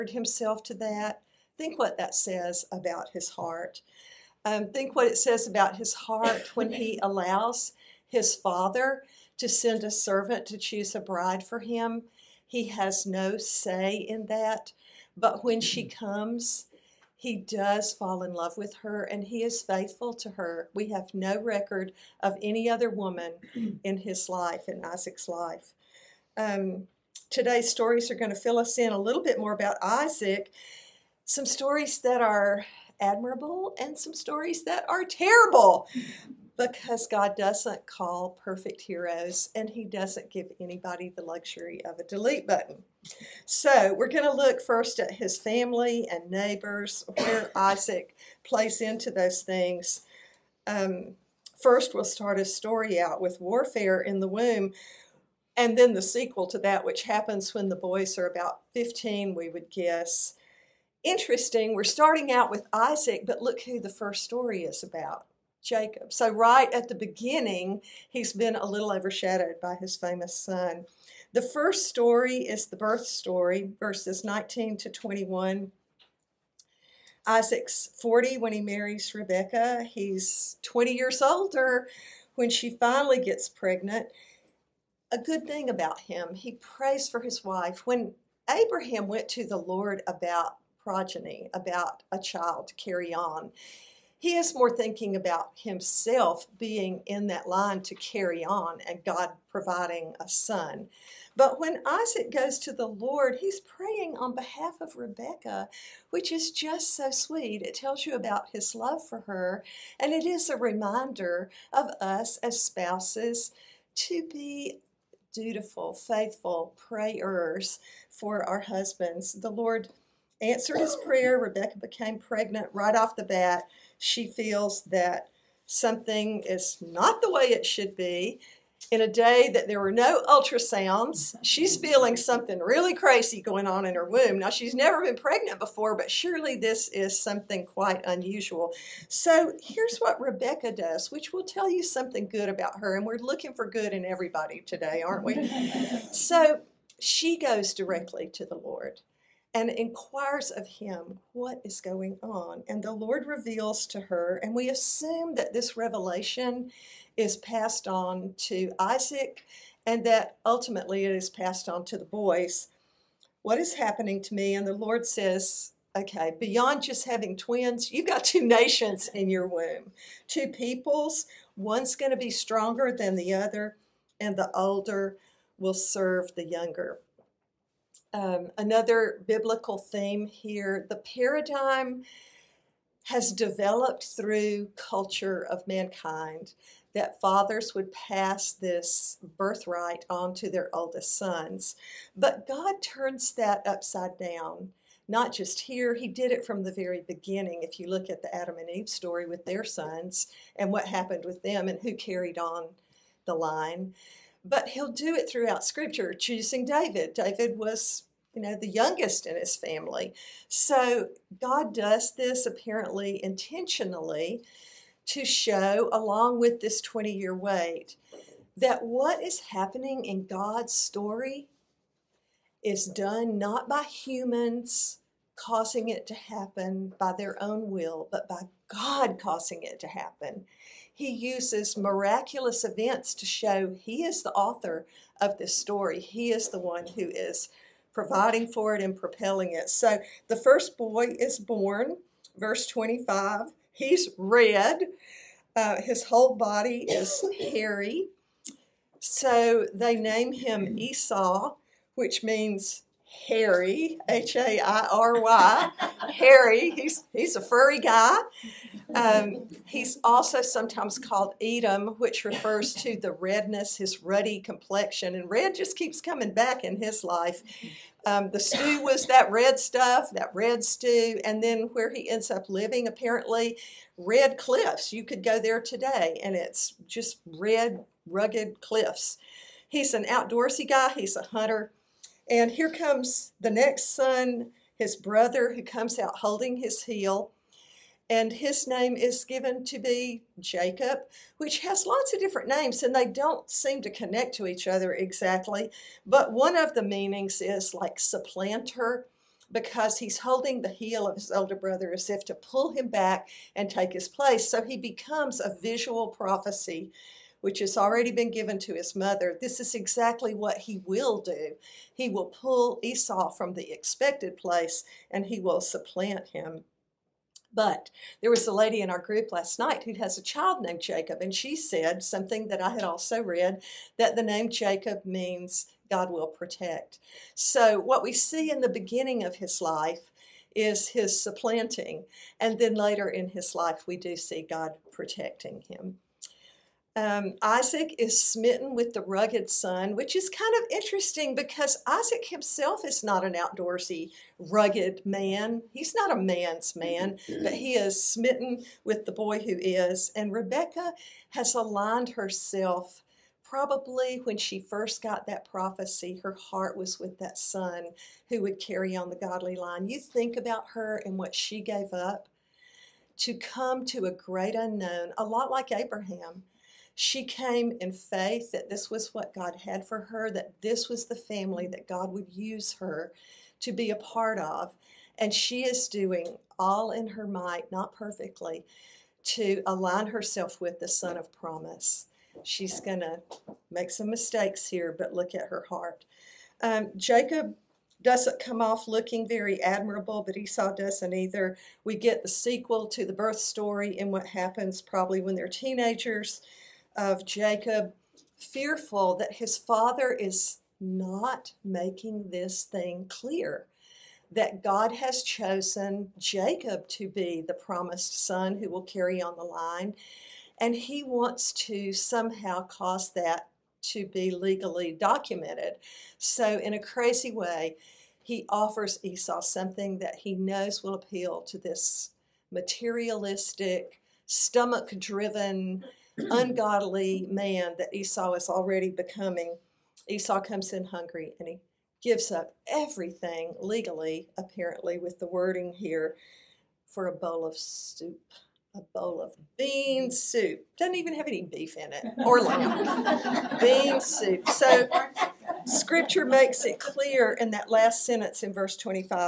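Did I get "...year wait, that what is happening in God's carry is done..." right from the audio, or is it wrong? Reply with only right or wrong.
wrong.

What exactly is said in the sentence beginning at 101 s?
But when Isaac goes to the Lord, he's praying on behalf of Rebecca, which is just so sweet.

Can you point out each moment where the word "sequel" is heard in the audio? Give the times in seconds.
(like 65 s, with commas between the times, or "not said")
56 s, 392 s.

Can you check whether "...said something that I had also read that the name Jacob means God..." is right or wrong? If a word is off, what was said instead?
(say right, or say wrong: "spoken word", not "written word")
right.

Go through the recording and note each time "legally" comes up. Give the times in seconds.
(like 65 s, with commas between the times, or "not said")
414 s, 433 s.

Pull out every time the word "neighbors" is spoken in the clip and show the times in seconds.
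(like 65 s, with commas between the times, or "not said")
46 s.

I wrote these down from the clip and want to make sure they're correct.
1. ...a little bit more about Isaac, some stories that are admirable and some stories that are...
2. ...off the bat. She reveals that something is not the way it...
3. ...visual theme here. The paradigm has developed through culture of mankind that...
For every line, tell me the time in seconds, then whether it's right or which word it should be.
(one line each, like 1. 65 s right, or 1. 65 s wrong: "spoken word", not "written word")
1. 28 s right
2. 122 s wrong: "feels", not "reveals"
3. 179 s wrong: "biblical", not "visual".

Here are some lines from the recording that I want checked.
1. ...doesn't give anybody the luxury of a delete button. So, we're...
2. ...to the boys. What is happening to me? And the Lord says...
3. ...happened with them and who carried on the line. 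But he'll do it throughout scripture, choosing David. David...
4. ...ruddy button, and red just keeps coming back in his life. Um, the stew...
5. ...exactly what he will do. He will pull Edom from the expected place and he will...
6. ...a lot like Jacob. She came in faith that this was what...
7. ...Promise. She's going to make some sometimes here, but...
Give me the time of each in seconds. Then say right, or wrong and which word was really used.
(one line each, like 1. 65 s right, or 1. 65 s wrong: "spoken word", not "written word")
1. 39 s right
2. 161 s right
3. 200 s right
4. 264 s wrong: "complexion", not "button"
5. 309 s wrong: "Esau", not "Edom"
6. 365 s wrong: "Abraham", not "Jacob"
7. 381 s wrong: "mistakes", not "sometimes".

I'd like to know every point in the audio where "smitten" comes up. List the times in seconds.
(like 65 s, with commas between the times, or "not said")
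338 s, 348 s.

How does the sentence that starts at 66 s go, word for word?
So, right at the beginning, he's been a little overshadowed by his famous son.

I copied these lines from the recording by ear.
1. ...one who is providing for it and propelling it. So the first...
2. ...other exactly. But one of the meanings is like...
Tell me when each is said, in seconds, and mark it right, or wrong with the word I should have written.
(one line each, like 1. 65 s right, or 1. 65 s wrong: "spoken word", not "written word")
1. 236 s right
2. 294 s right.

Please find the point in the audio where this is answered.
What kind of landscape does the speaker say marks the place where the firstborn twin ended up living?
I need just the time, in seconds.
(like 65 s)
273 s.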